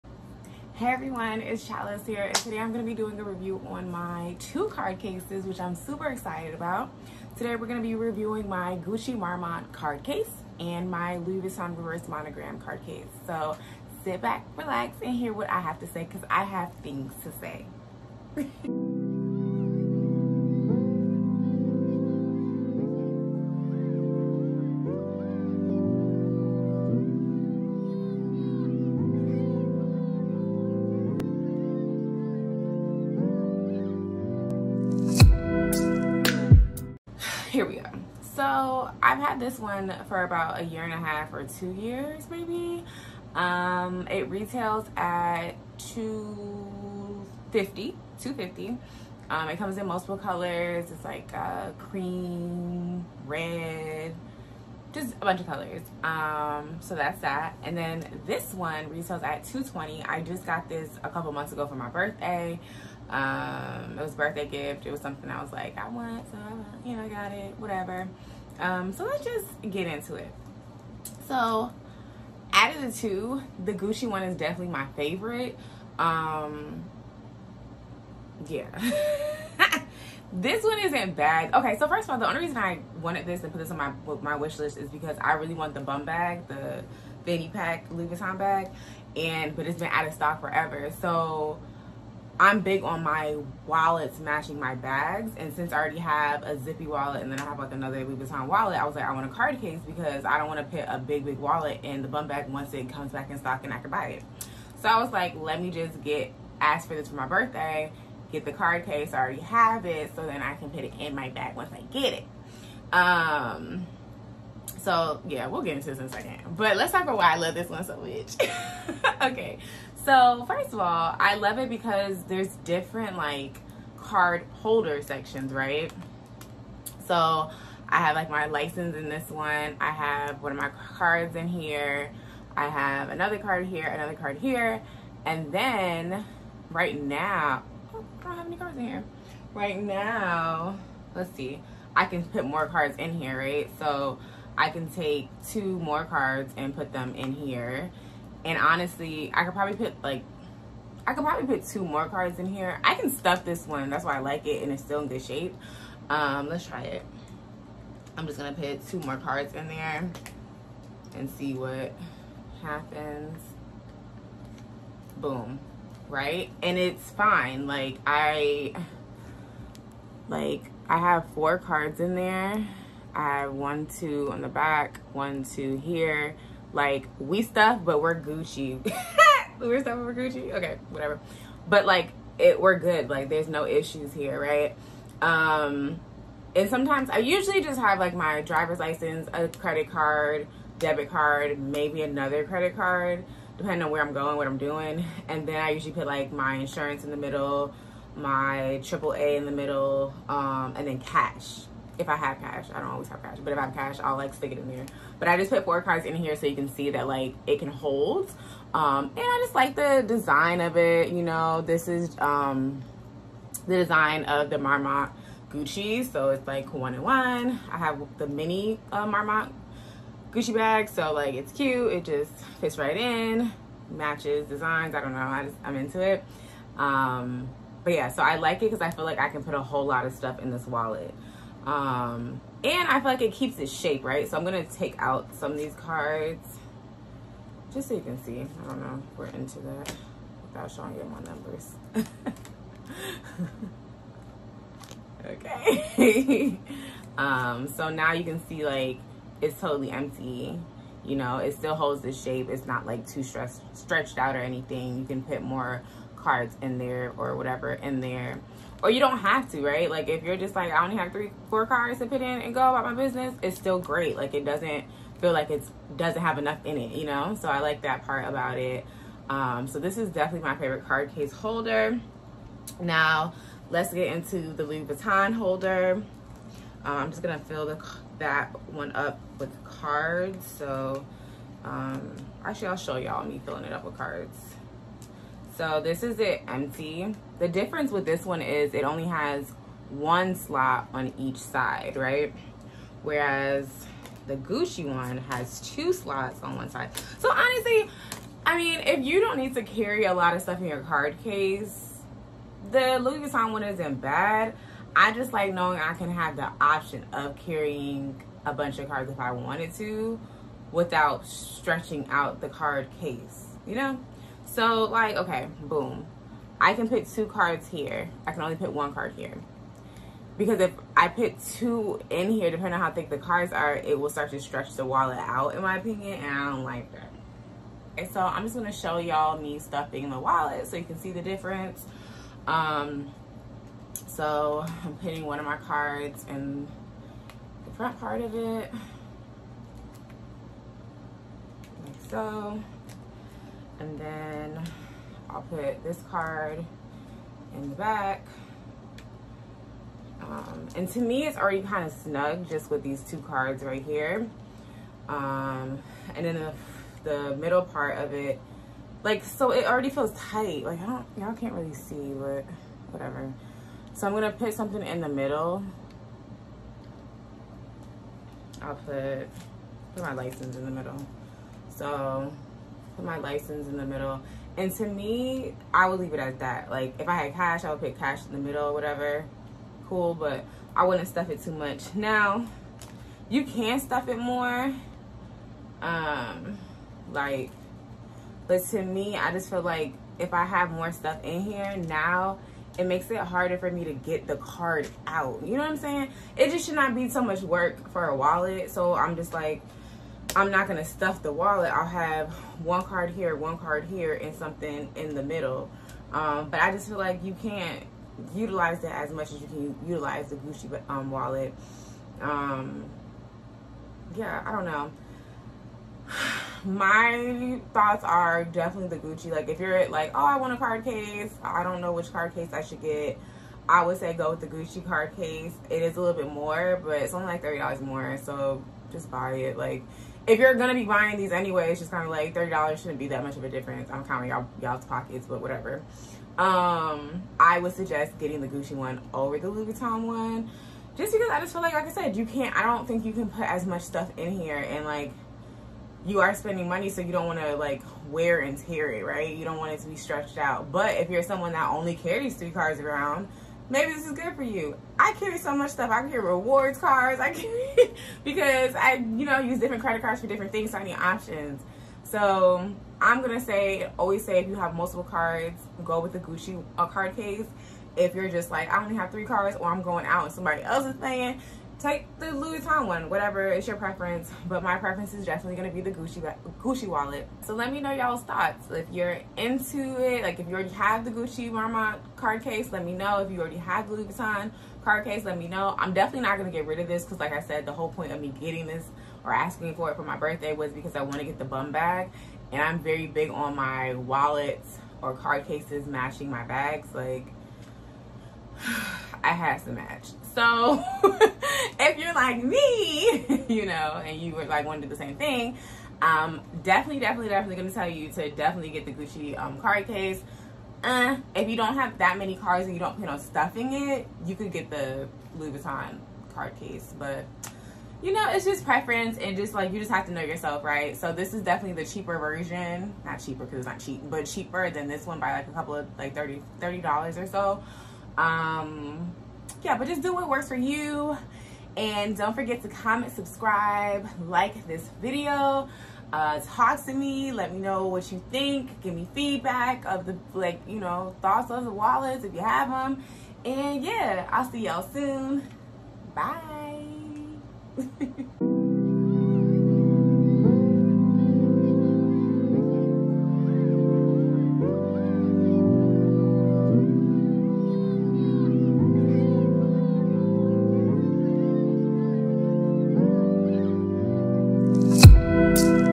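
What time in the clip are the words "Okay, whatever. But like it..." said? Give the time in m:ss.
3:00.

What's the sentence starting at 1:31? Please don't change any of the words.
So I'm big on my wallets matching my bags.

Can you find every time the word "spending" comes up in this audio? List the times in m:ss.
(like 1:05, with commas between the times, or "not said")
7:26.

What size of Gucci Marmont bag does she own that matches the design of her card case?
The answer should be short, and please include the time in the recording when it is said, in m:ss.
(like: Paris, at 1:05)
mini, at 3:38.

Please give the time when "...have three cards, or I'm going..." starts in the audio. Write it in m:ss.
7:48.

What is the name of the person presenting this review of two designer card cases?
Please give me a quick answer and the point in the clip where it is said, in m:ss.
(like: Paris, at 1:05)
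Chalice, at 0:01.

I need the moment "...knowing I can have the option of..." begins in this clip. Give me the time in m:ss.
5:05.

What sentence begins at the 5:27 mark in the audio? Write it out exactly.
And so I'm just gonna show y'all me stuffing the wallet so you can see the difference.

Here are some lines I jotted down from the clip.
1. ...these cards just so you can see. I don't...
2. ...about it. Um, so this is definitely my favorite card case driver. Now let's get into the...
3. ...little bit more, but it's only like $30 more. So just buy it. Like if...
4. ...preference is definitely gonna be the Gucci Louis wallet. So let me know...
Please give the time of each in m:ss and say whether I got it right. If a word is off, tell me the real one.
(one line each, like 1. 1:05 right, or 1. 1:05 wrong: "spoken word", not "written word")
1. 3:55 right
2. 4:28 wrong: "holder", not "driver"
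3. 7:06 right
4. 7:54 wrong: "Gucci", not "Louis".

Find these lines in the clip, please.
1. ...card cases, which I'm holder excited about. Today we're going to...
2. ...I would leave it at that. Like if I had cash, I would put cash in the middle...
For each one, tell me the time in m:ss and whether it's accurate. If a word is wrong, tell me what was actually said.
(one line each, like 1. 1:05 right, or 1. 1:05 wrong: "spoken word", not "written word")
1. 0:04 wrong: "super", not "holder"
2. 6:15 right.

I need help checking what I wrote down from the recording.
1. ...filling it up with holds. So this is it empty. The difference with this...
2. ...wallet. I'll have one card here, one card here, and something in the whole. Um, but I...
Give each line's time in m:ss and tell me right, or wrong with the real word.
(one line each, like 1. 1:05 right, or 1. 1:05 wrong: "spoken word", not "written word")
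1. 4:43 wrong: "cards", not "holds"
2. 6:41 wrong: "middle", not "whole".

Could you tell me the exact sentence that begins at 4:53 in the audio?
Whereas the Gucci one has two slots on one side.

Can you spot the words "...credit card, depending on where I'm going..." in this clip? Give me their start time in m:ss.
3:12.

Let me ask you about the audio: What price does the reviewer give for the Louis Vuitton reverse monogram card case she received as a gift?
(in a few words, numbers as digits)
220.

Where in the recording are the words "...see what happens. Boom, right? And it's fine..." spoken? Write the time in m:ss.
2:41.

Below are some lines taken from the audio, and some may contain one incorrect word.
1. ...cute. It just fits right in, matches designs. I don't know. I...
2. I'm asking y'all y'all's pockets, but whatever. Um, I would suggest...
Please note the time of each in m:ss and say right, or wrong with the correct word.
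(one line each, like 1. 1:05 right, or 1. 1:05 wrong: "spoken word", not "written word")
1. 3:41 right
2. 7:13 wrong: "counting", not "asking".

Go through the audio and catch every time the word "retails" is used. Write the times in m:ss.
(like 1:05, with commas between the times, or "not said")
0:44, 0:58.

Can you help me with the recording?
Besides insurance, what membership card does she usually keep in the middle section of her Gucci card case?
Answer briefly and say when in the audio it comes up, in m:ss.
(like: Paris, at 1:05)
AAA, at 3:18.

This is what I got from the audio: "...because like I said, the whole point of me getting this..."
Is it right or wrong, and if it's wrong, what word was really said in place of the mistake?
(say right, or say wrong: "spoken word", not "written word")
right.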